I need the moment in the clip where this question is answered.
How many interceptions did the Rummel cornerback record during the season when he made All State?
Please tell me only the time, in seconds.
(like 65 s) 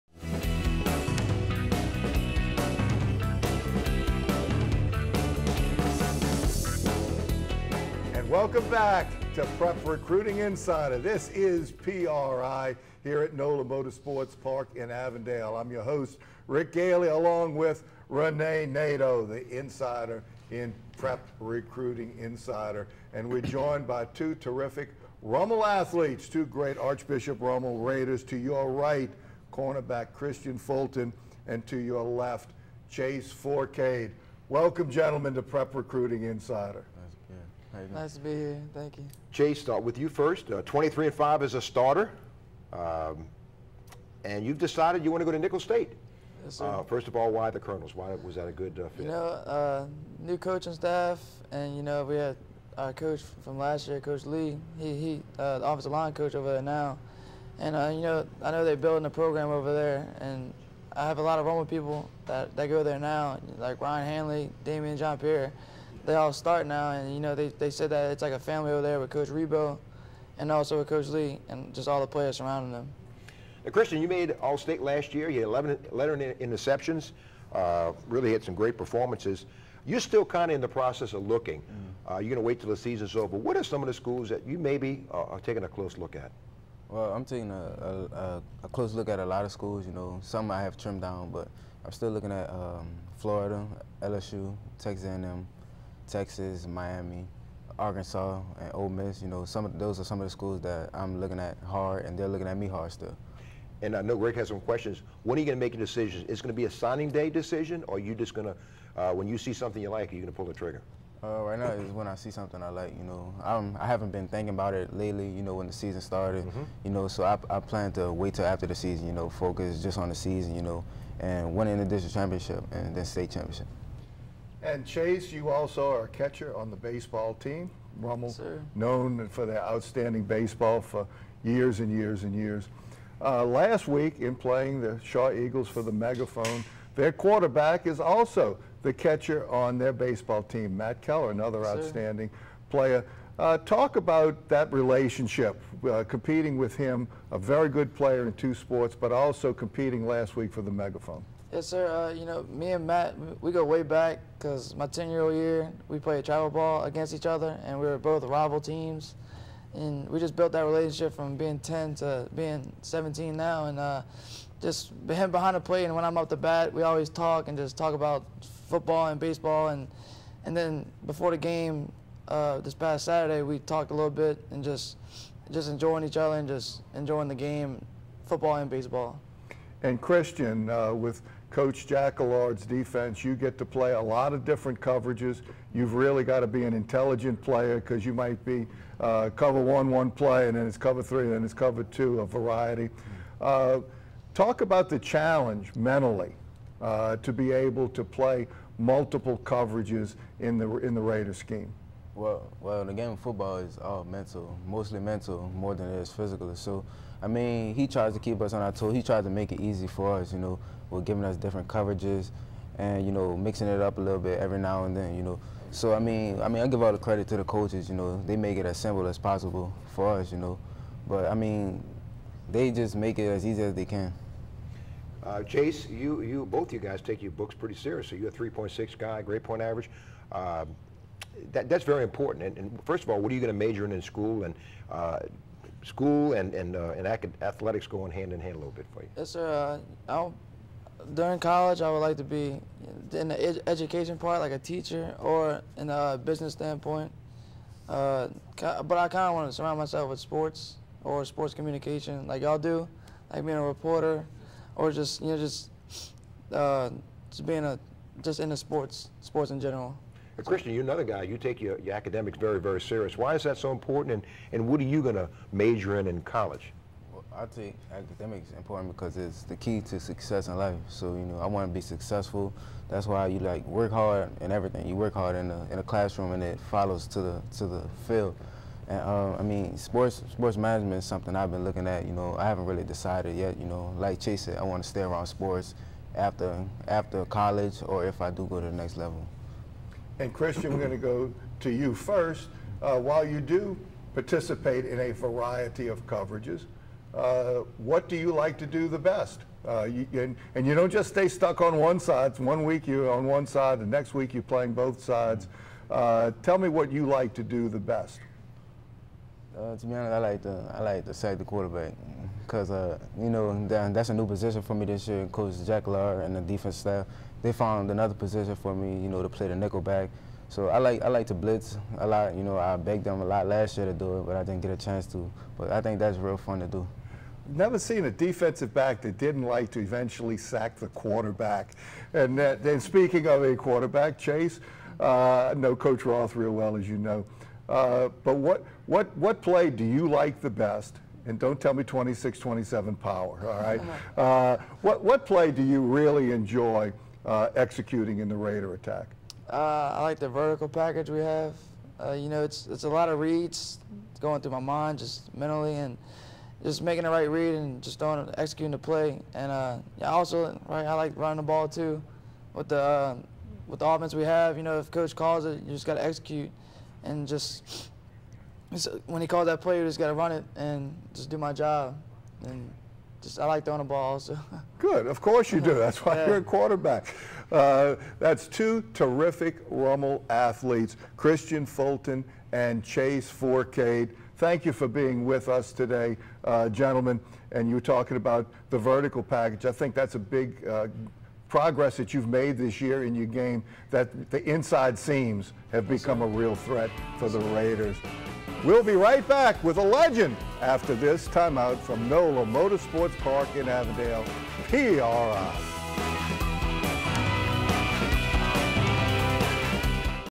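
75 s.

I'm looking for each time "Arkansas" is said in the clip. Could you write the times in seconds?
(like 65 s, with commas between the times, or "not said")
97 s.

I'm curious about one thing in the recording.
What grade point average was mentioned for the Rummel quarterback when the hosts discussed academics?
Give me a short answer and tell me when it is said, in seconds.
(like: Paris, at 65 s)
3.6, at 228 s.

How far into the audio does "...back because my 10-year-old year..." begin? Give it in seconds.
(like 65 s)
153 s.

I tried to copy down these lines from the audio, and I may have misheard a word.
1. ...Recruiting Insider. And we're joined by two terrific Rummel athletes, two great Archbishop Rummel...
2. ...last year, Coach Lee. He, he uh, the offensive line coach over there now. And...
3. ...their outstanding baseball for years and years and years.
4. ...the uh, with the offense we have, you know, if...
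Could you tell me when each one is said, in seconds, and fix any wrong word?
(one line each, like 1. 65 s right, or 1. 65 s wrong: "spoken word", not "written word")
1. 21 s right
2. 53 s right
3. 129 s right
4. 362 s right.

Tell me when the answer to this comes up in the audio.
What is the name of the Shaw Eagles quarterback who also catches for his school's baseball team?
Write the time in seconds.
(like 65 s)
140 s.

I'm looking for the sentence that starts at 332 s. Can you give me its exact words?
And uh, that, speaking of a quarterback, Chase, uh, know Coach Roth real well, as you know.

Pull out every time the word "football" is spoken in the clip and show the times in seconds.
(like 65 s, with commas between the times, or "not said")
168 s, 178 s, 203 s.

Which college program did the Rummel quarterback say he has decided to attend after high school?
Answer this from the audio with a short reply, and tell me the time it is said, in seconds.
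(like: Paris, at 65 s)
Nicholls State, at 45 s.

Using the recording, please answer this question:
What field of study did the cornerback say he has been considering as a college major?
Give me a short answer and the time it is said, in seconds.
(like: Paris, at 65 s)
Sports management, at 280 s.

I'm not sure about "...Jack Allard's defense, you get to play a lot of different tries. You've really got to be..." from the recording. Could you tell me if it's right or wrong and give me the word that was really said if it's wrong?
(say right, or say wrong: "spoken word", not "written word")
wrong: "coverages", not "tries".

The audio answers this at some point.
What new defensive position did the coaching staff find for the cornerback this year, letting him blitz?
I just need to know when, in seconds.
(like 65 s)
319 s.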